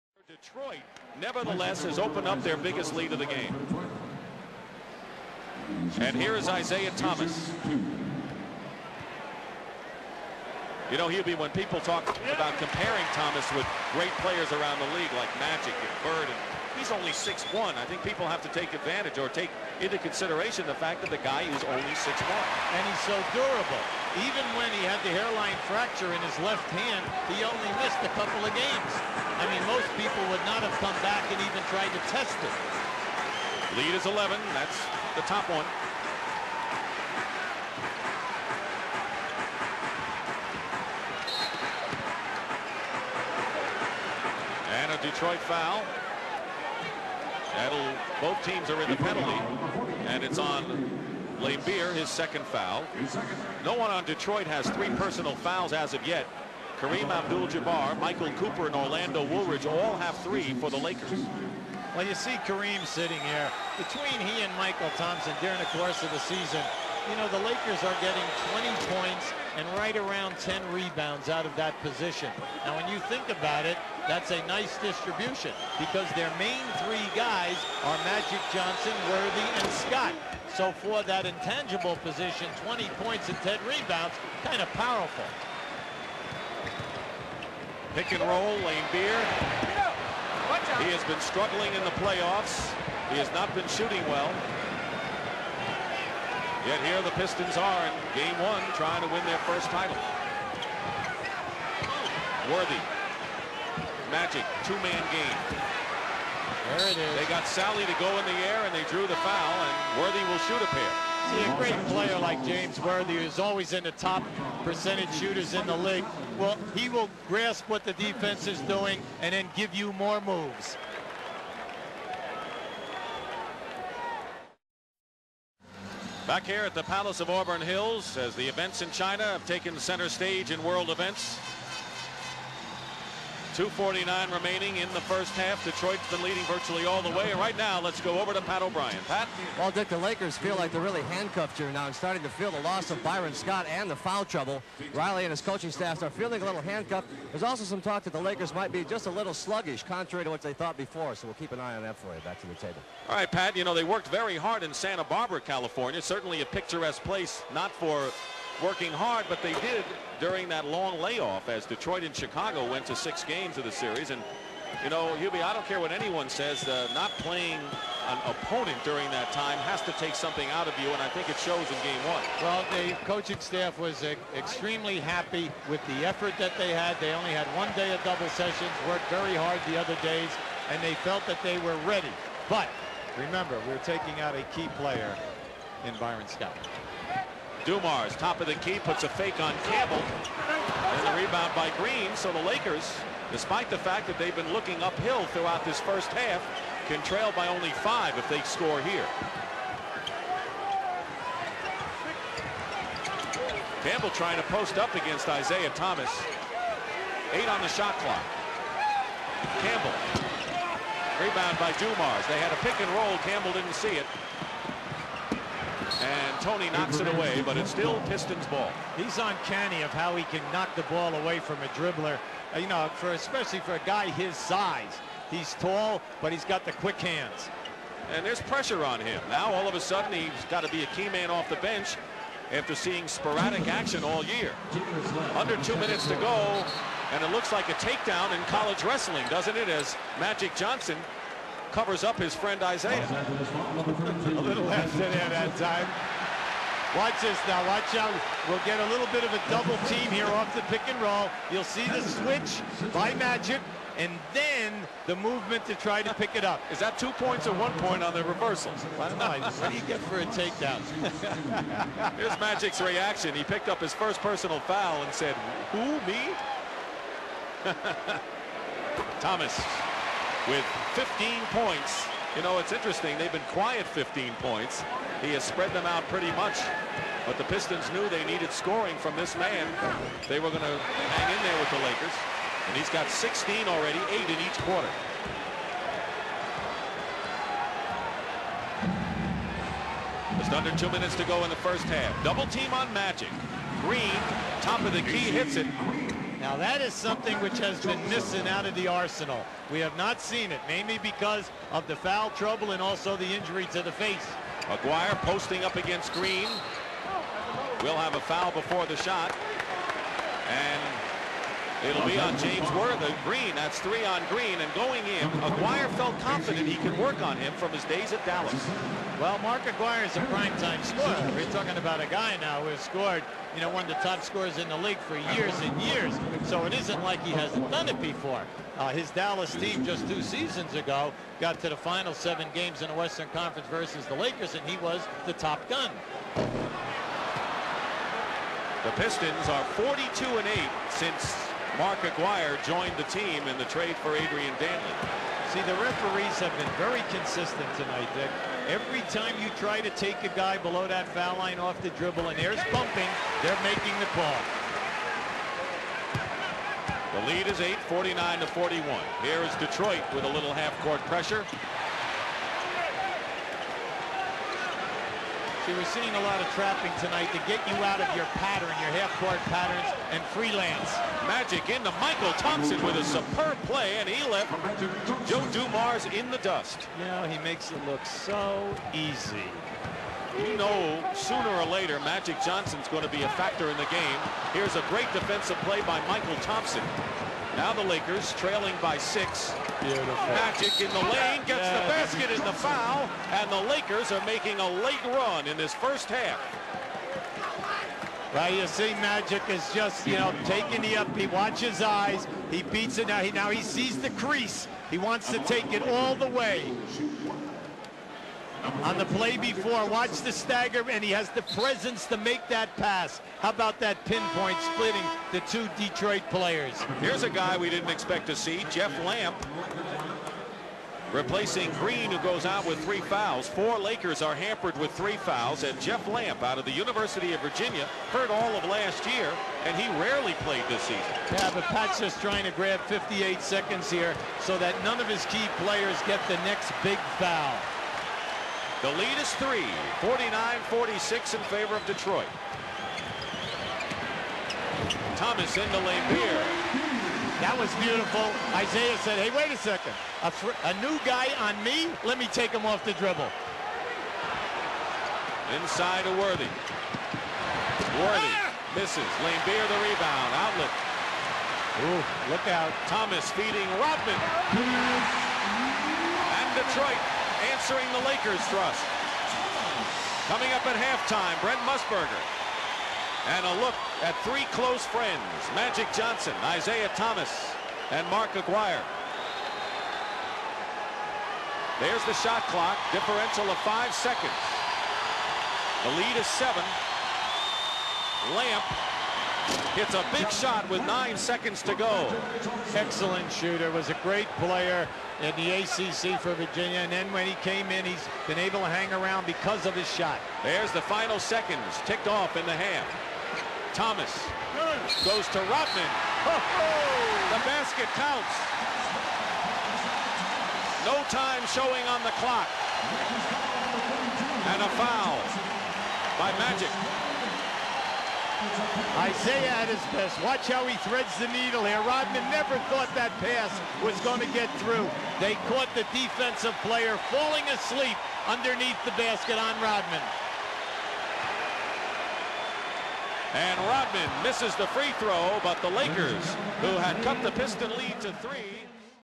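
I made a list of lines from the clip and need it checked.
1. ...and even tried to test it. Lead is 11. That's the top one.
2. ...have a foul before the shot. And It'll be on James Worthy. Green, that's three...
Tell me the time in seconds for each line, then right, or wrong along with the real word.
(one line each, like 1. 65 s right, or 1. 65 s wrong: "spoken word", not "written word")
1. 31 s right
2. 307 s right.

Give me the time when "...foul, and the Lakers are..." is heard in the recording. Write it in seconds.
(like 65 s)
392 s.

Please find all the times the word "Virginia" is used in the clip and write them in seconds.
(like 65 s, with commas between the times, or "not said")
427 s, 496 s.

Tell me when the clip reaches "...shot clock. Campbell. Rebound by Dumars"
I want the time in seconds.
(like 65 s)
207 s.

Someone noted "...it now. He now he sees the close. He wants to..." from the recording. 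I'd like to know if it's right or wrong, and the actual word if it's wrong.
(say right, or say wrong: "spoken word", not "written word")
wrong: "crease", not "close".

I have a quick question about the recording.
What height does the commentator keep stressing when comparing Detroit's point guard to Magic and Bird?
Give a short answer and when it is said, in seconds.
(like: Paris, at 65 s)
6'1", at 16 s.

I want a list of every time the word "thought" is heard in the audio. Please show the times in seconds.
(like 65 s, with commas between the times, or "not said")
150 s, 522 s.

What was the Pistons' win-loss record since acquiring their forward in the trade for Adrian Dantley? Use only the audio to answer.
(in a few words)
42 and 8.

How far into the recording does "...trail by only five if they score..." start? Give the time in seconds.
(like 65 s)
197 s.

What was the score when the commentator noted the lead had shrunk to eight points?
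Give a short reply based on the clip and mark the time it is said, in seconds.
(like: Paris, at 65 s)
49 to 41, at 357 s.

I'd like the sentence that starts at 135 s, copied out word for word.
Detroit's been leading virtually all the way.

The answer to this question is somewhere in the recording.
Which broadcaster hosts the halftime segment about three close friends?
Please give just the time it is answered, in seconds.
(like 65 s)
471 s.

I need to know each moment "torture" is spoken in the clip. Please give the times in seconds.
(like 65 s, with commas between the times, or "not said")
not said.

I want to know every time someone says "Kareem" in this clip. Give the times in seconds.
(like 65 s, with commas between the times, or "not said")
56 s, 62 s.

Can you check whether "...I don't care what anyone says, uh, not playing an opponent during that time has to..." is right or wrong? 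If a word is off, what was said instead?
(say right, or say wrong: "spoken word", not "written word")
right.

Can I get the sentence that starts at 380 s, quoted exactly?
You know, sooner or later, Magic Johnson's going to be a factor in the game.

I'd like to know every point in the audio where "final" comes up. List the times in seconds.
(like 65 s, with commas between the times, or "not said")
331 s, 500 s.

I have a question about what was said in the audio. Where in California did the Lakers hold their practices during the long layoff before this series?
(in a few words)
Santa Barbara.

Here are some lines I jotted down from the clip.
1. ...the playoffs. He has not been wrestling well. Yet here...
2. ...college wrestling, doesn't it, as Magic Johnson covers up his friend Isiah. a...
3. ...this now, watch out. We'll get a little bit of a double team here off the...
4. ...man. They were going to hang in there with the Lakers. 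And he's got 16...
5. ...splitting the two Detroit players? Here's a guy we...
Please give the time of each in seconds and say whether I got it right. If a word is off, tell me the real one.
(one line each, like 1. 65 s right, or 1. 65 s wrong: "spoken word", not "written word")
1. 91 s wrong: "shooting", not "wrestling"
2. 238 s right
3. 247 s right
4. 279 s right
5. 414 s right.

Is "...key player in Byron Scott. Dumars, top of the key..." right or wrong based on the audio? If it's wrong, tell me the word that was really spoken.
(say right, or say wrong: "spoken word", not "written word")
right.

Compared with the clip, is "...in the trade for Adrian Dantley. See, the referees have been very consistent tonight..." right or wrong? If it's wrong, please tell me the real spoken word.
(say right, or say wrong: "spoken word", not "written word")
right.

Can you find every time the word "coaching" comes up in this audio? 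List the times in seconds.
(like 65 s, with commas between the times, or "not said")
145 s, 173 s.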